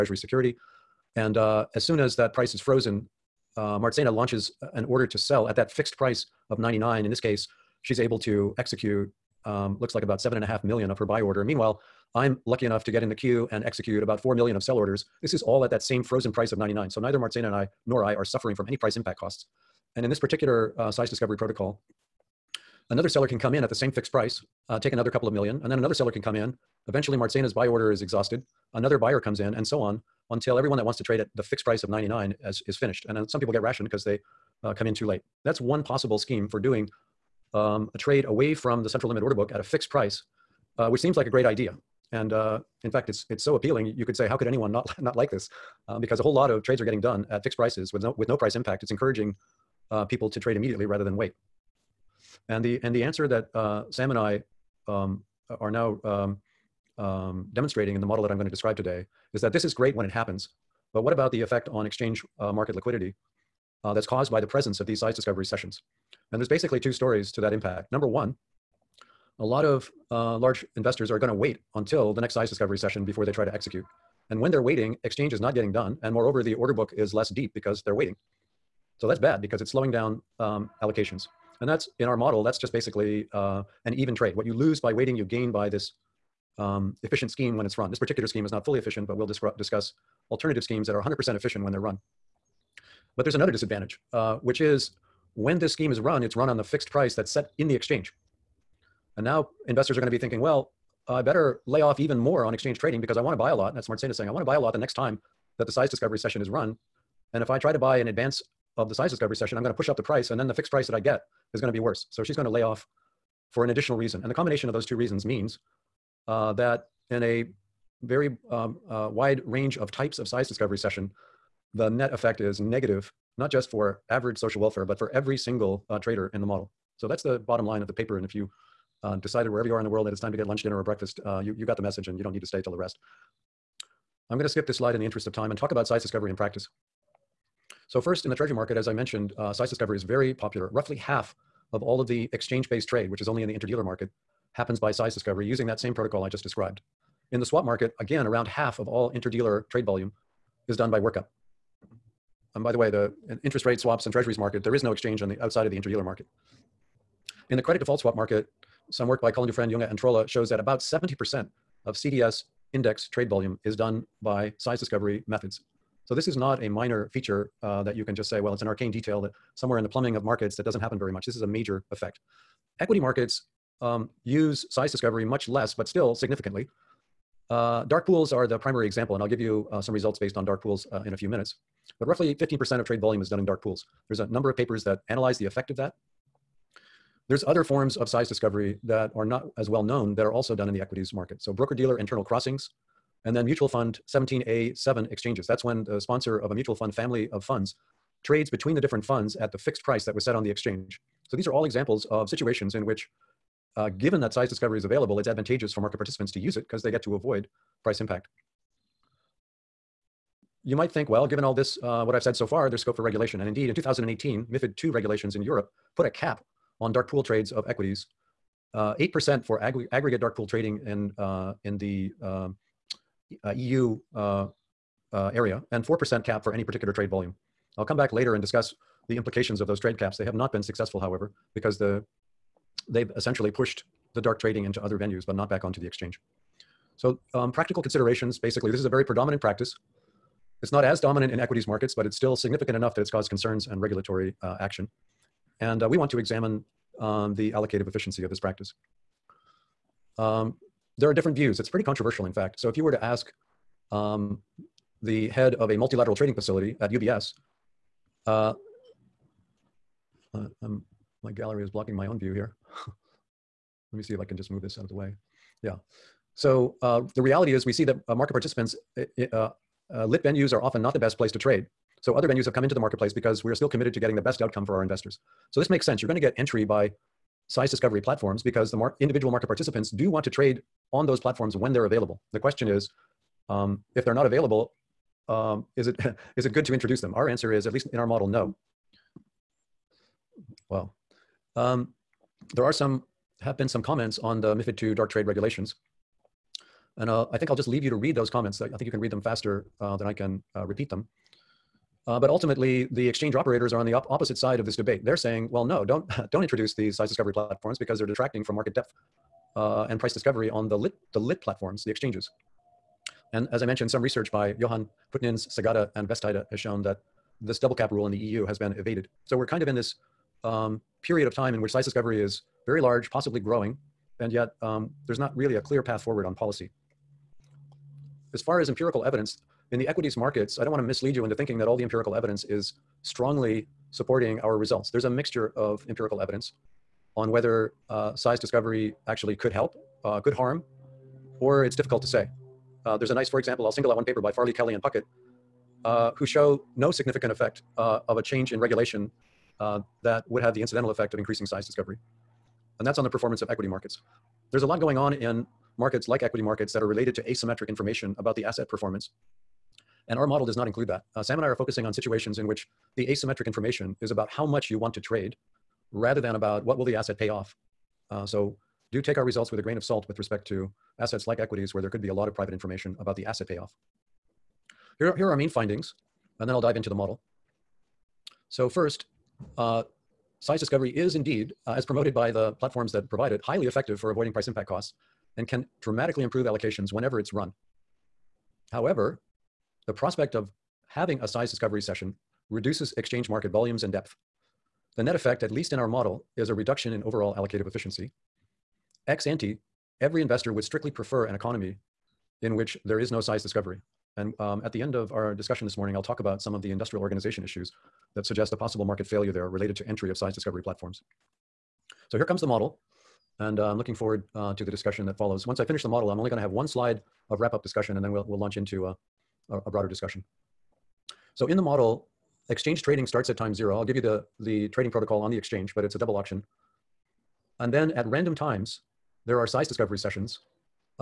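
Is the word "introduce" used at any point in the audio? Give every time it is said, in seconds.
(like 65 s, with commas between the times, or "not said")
286 s, 306 s.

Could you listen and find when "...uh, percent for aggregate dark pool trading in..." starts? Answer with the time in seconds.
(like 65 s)
219 s.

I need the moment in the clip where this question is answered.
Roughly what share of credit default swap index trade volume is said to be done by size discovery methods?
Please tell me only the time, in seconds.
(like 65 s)
160 s.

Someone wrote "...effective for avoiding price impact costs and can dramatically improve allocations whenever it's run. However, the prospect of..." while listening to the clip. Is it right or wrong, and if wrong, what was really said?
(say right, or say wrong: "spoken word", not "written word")
right.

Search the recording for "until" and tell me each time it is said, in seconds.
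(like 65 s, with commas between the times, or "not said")
30 s, 71 s.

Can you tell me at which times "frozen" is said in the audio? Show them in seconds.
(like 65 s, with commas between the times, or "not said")
2 s, 16 s.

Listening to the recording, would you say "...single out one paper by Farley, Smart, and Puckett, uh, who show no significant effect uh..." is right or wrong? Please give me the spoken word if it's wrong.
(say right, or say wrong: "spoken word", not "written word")
wrong: "Kelley", not "Smart".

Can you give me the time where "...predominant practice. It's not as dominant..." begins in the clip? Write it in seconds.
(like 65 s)
239 s.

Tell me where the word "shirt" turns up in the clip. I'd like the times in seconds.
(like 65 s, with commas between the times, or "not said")
not said.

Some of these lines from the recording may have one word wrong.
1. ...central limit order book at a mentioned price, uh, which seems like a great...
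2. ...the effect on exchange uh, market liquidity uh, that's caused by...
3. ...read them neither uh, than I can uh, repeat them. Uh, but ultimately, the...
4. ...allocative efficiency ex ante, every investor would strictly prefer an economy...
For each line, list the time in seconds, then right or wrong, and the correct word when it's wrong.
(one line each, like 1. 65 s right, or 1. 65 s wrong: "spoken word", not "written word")
1. 38 s wrong: "fixed", not "mentioned"
2. 61 s right
3. 298 s wrong: "faster", not "neither"
4. 397 s right.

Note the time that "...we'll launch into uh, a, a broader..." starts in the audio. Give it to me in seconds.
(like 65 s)
418 s.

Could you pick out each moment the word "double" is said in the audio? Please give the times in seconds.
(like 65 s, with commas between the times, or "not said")
317 s, 425 s.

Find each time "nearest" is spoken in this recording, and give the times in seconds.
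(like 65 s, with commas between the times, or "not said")
not said.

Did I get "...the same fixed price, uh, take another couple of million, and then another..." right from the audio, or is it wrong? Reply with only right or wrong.
right.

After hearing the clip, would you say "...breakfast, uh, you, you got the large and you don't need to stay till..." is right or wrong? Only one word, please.
wrong.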